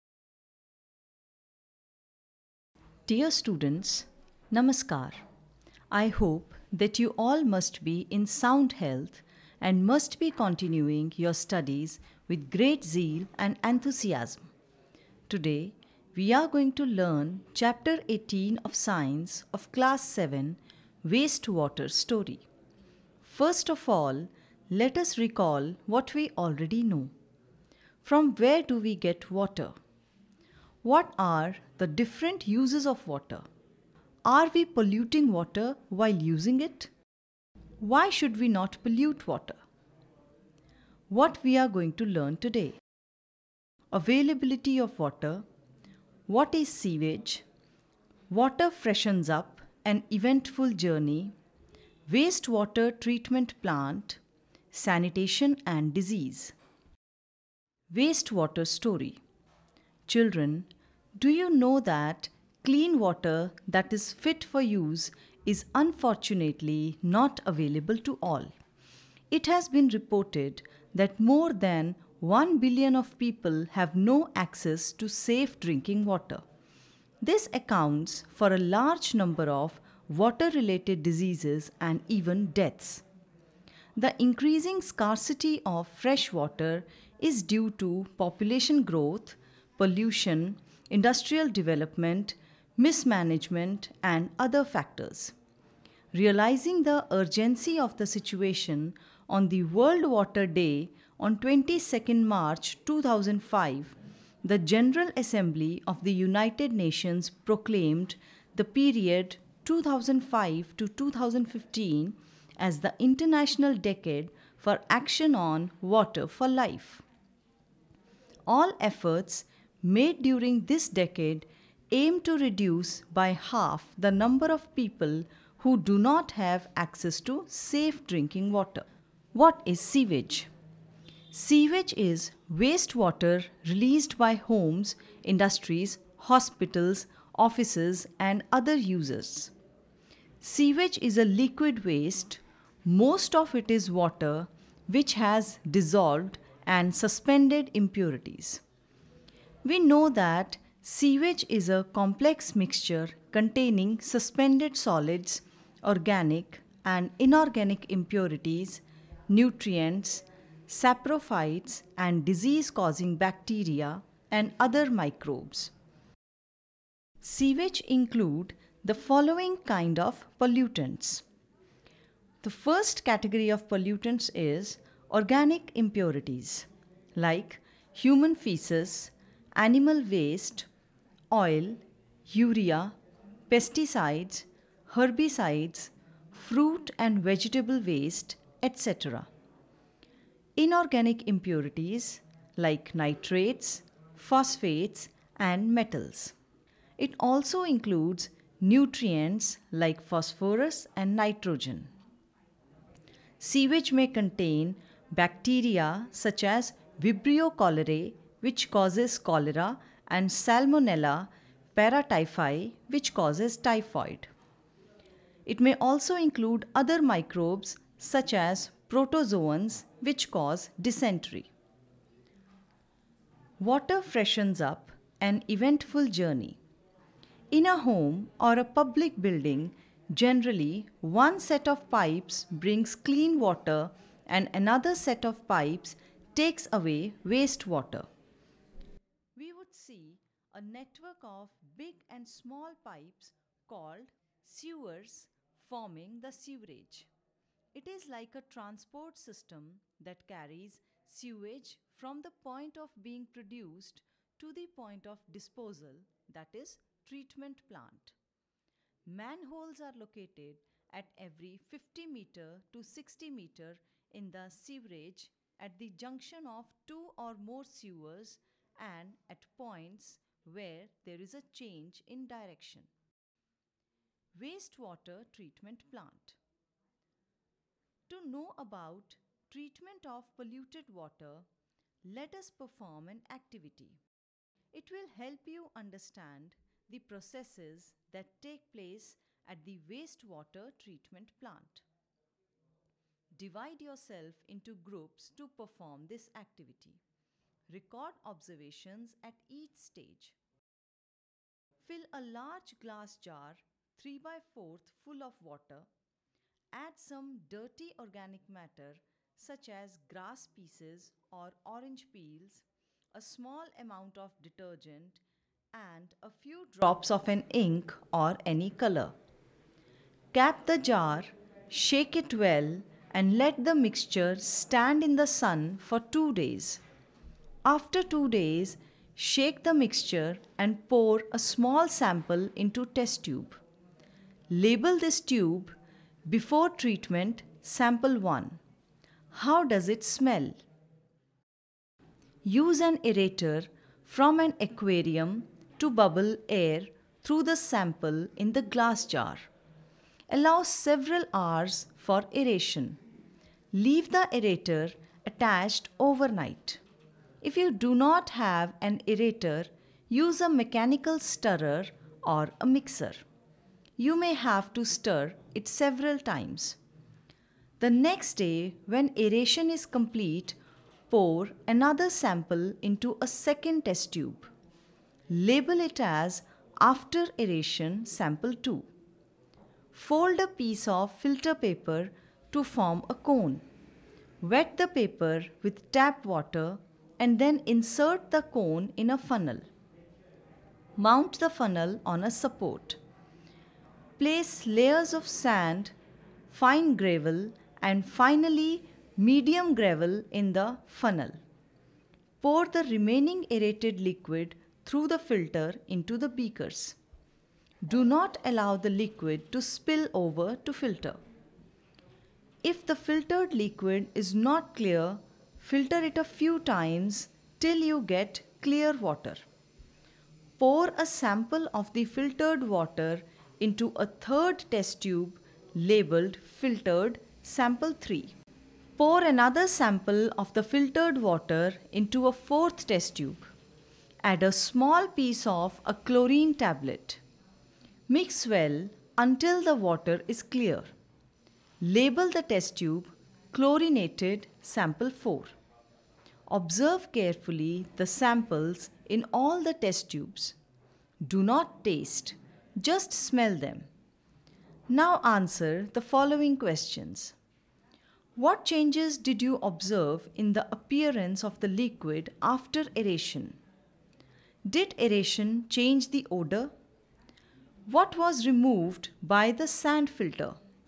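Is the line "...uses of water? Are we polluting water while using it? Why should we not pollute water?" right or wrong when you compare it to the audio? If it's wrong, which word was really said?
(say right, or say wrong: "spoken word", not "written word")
right.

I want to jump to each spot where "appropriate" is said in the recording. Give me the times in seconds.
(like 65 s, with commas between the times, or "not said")
not said.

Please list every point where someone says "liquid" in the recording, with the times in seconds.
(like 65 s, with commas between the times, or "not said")
141 s, 404 s, 408 s, 413 s, 461 s.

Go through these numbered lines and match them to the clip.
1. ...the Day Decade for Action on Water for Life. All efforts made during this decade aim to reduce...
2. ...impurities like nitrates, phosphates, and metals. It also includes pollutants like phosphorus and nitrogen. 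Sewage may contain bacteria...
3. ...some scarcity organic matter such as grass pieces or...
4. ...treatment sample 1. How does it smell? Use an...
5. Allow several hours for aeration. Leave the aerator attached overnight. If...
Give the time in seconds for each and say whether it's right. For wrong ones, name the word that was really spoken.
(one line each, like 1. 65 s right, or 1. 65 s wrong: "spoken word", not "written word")
1. 112 s wrong: "International", not "Day"
2. 191 s wrong: "nutrients", not "pollutants"
3. 306 s wrong: "dirty", not "scarcity"
4. 336 s right
5. 350 s right.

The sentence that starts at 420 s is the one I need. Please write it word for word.
Pour a sample of the filtered water into a third test tube labeled filtered sample 3.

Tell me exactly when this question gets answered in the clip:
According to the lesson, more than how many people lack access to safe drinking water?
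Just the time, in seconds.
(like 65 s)
72 s.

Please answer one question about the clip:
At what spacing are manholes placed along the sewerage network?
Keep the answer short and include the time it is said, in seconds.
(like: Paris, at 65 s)
50 to 60 meters, at 261 s.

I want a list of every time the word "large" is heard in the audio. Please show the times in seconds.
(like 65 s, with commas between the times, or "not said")
78 s, 302 s.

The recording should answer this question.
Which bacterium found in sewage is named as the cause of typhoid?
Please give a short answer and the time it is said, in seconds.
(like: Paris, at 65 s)
Salmonella paratyphi, at 210 s.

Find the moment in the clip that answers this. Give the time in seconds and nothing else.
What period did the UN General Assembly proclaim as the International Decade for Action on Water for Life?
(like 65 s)
109 s.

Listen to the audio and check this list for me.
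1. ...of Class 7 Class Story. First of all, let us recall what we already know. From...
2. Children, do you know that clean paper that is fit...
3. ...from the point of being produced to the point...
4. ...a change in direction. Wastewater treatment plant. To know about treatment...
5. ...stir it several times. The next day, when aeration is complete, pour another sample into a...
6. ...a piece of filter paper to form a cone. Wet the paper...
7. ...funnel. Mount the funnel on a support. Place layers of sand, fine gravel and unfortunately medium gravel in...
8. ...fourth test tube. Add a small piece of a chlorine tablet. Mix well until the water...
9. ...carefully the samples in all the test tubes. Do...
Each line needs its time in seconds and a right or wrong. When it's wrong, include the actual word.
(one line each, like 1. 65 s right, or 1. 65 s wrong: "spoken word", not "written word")
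1. 19 s wrong: "Wastewater", not "Class"
2. 60 s wrong: "water", not "paper"
3. 251 s right
4. 271 s right
5. 364 s right
6. 380 s right
7. 389 s wrong: "finally", not "unfortunately"
8. 432 s right
9. 447 s right.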